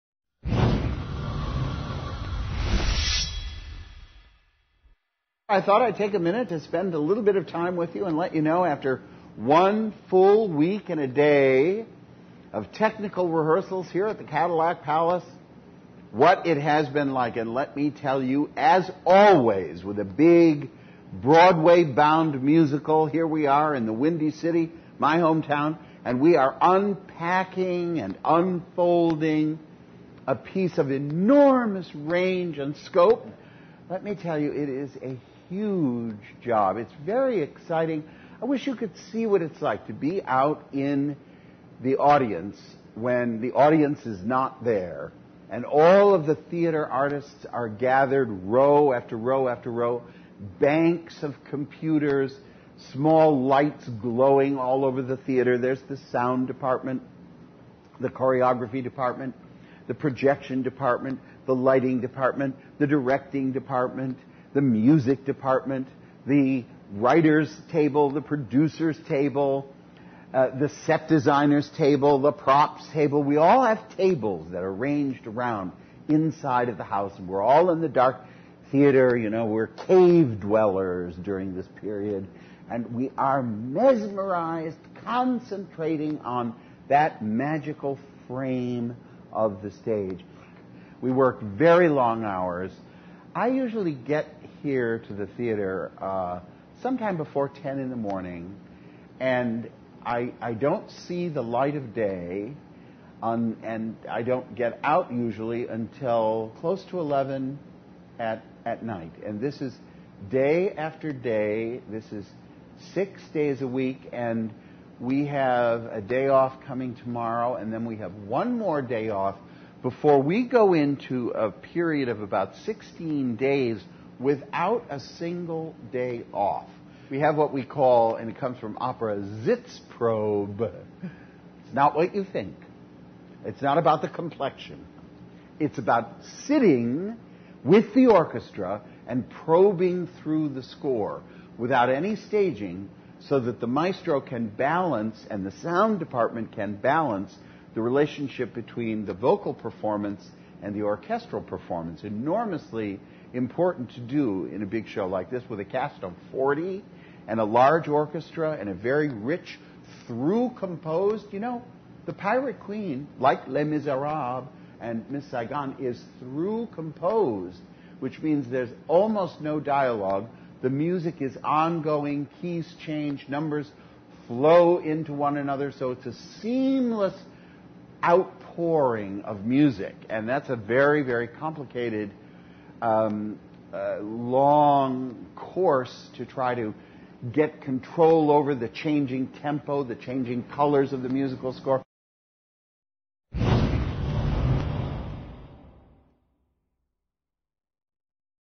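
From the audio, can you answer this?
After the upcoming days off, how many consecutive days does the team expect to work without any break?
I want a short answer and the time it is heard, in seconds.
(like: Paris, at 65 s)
16, at 122 s.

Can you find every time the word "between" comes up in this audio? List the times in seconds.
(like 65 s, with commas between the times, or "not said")
148 s.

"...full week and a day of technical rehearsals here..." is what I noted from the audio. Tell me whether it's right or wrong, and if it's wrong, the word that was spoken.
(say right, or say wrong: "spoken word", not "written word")
right.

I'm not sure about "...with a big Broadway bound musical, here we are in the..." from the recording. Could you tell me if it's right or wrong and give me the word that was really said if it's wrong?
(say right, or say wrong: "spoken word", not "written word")
right.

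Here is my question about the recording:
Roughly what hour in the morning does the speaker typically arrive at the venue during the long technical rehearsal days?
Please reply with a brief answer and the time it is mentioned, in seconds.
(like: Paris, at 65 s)
10, at 97 s.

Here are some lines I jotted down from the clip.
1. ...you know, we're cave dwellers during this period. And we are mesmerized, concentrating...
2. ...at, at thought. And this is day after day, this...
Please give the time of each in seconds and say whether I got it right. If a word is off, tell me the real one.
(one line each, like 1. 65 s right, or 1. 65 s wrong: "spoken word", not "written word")
1. 79 s right
2. 108 s wrong: "night", not "thought".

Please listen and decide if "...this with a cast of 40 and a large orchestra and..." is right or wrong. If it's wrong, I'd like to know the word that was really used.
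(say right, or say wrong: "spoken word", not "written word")
right.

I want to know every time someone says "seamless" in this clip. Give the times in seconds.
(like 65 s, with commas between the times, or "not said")
176 s.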